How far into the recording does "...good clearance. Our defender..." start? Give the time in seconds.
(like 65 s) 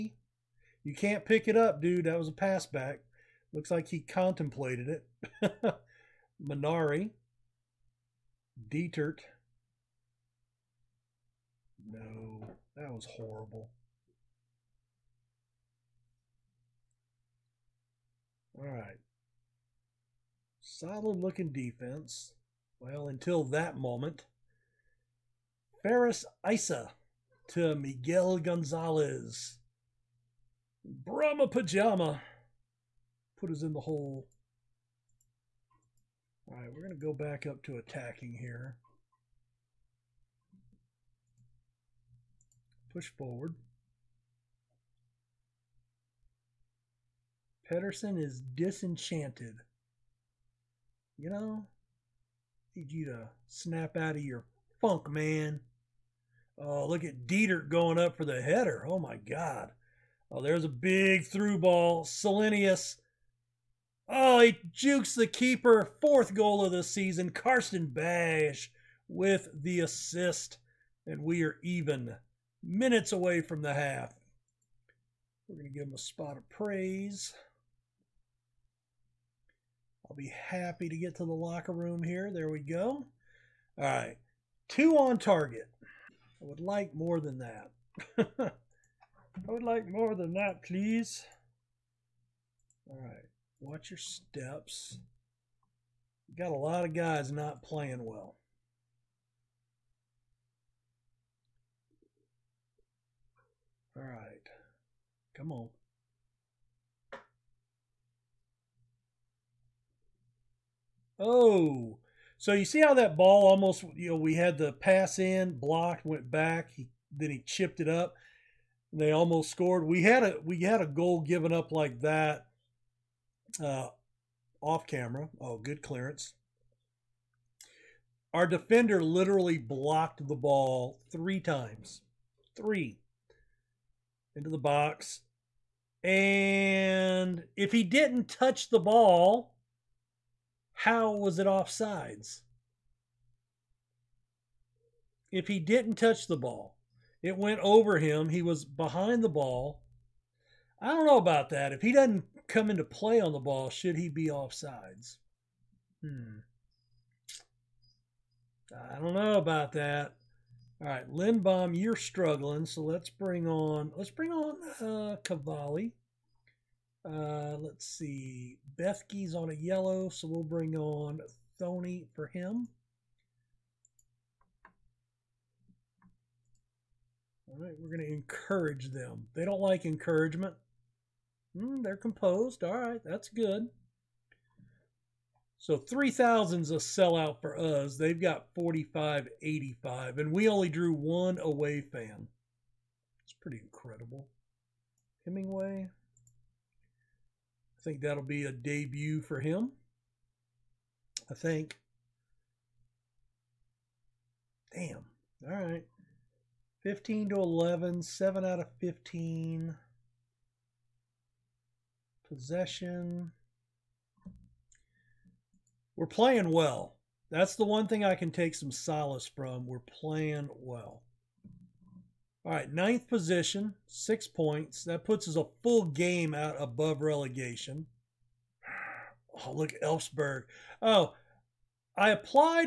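125 s.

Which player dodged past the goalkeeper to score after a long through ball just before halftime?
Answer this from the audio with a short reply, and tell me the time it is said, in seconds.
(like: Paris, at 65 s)
Selenius, at 62 s.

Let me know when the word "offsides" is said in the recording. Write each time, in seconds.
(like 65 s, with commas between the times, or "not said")
141 s, 154 s.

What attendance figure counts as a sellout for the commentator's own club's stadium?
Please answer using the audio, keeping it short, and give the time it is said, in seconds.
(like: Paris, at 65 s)
3,000, at 185 s.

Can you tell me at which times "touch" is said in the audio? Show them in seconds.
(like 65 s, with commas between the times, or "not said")
138 s, 145 s.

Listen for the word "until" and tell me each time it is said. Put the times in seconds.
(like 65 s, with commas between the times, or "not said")
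23 s.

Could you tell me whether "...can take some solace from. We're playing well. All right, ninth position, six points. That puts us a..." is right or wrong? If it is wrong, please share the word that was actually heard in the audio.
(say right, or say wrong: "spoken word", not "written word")
right.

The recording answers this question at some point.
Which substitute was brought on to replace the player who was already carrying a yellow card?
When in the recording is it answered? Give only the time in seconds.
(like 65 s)
171 s.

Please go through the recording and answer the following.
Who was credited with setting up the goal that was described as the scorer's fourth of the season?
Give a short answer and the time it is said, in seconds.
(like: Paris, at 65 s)
Karsten Bash, at 67 s.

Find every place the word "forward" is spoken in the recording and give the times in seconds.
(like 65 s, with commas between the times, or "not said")
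43 s.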